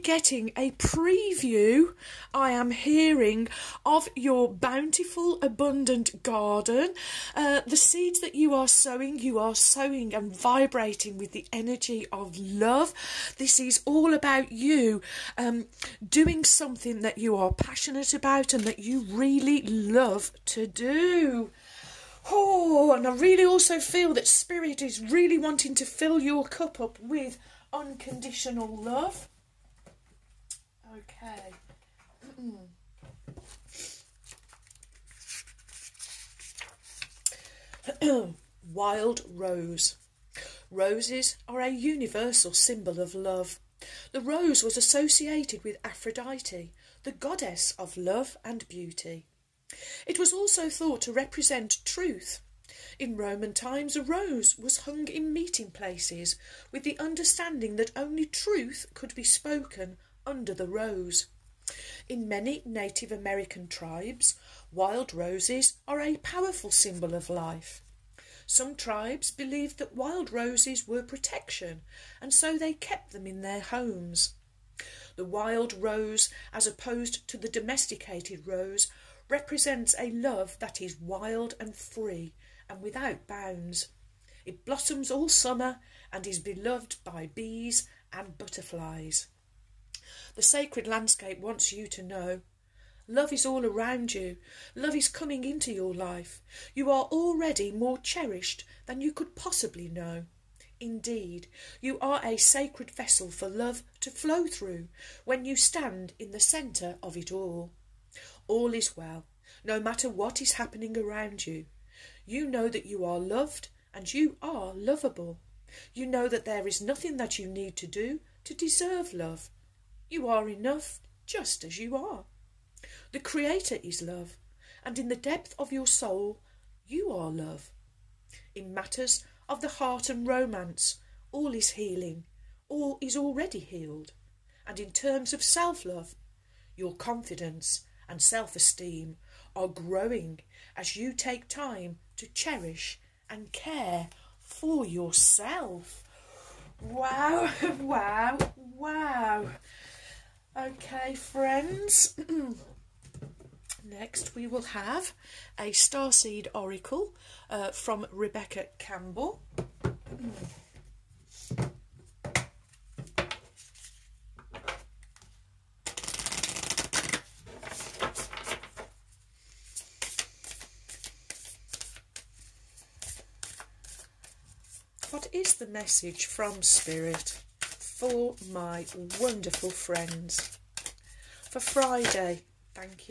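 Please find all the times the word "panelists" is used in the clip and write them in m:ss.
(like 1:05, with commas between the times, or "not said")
not said.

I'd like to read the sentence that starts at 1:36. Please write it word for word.
You are already more cherished than you could possibly know.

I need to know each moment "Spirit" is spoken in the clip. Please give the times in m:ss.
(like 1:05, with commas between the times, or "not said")
0:24, 2:56.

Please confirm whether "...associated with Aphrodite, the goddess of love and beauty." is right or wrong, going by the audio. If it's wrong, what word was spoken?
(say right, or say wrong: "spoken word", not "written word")
right.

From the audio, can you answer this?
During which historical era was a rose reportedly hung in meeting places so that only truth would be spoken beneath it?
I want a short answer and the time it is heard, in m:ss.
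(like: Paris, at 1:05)
Roman times, at 0:53.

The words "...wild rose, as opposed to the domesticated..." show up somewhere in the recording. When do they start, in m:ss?
1:15.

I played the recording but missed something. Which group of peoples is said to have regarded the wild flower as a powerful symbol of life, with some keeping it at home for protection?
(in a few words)
Native American tribes.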